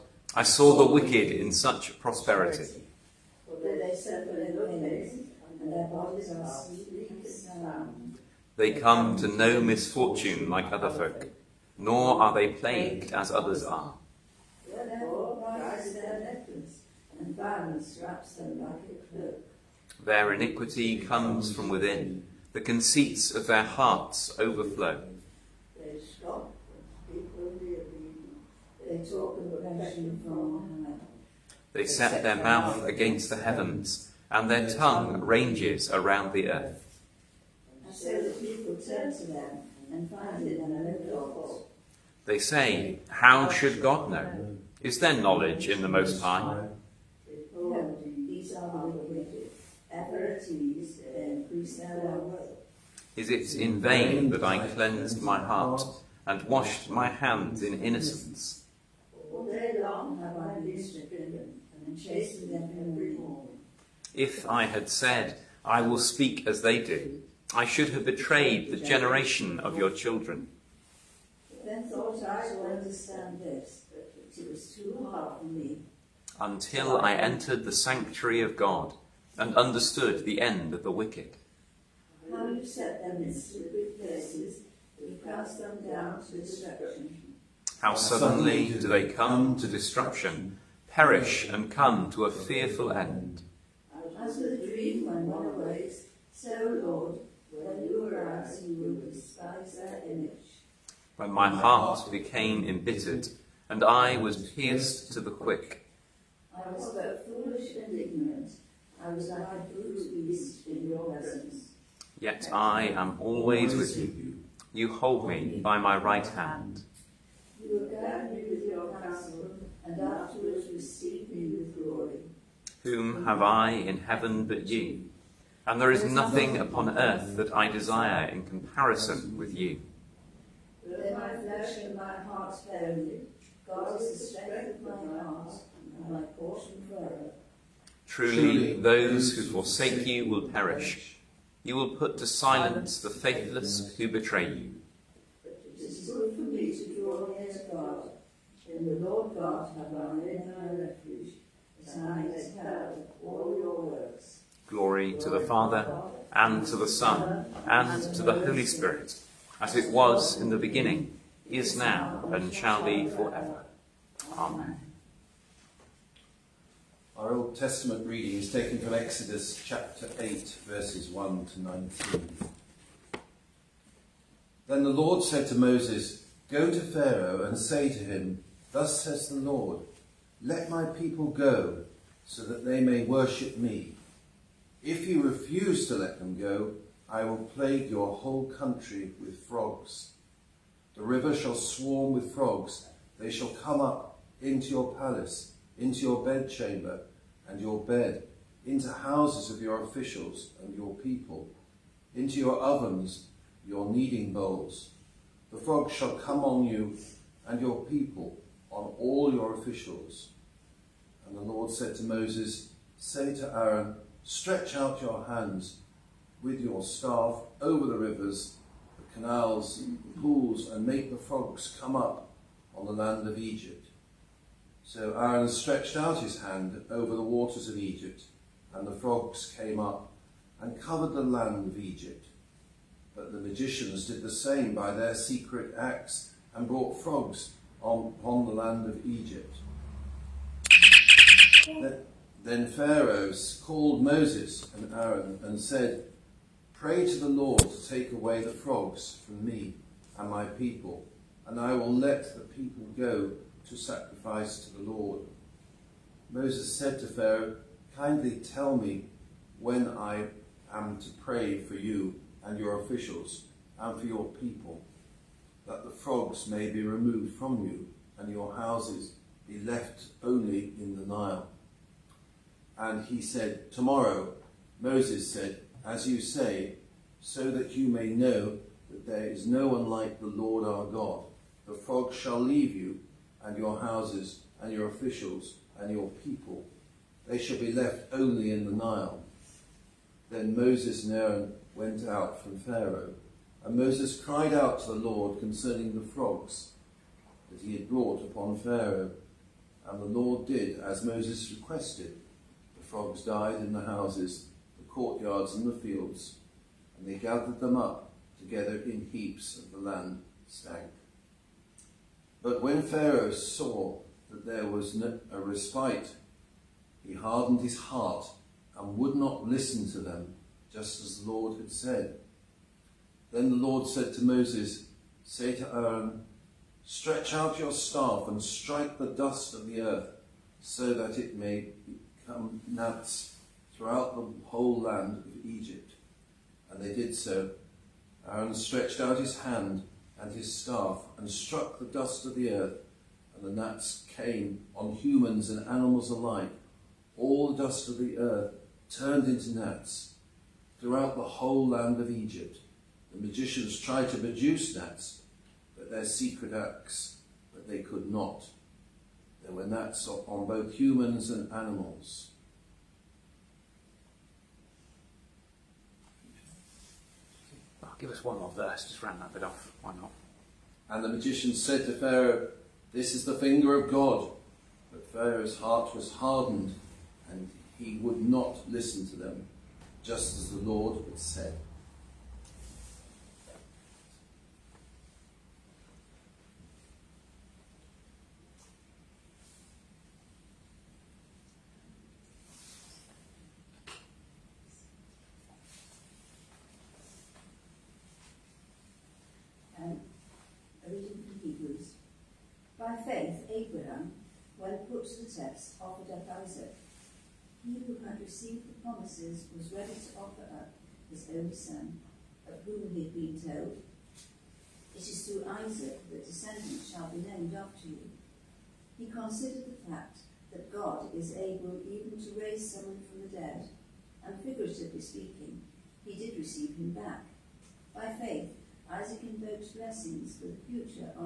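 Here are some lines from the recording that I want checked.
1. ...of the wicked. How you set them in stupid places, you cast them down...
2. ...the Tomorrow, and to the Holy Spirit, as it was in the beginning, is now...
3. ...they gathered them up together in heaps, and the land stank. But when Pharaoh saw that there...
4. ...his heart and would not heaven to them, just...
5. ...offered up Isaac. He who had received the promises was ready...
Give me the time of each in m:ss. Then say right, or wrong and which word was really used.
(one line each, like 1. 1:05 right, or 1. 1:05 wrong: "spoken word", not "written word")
1. 1:20 right
2. 2:36 wrong: "Son", not "Tomorrow"
3. 5:07 right
4. 5:17 wrong: "listen", not "heaven"
5. 6:45 right.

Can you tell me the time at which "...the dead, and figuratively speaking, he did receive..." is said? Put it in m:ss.
7:03.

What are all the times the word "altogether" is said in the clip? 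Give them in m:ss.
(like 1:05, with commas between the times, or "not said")
not said.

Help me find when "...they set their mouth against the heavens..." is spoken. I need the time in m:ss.
0:31.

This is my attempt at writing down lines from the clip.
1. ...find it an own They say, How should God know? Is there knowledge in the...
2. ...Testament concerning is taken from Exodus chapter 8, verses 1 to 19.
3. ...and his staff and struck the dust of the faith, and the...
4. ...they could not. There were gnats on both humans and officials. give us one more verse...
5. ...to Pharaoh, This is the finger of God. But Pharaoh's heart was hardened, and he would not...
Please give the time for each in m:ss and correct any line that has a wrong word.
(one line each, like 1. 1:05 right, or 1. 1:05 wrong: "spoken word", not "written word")
1. 0:40 right
2. 2:47 wrong: "reading", not "concerning"
3. 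5:40 wrong: "earth", not "faith"
4. 5:57 wrong: "animals", not "officials"
5. 6:11 right.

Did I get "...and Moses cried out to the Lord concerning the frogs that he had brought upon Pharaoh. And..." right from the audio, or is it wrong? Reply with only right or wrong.
right.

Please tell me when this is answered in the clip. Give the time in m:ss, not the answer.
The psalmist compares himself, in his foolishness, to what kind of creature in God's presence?
1:49.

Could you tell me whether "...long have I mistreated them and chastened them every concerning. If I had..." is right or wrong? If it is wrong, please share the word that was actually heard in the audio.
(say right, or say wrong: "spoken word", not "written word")
wrong: "morning", not "concerning".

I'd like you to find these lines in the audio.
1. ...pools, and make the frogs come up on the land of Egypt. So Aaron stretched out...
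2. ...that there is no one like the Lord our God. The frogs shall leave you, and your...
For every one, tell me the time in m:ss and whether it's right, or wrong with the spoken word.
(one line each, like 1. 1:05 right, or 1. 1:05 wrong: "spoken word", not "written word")
1. 3:40 right
2. 4:38 right.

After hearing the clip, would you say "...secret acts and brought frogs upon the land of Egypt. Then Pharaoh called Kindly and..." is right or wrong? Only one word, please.
wrong.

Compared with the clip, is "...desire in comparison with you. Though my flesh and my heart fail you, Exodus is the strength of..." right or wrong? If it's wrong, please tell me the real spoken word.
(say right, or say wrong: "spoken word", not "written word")
wrong: "God", not "Exodus".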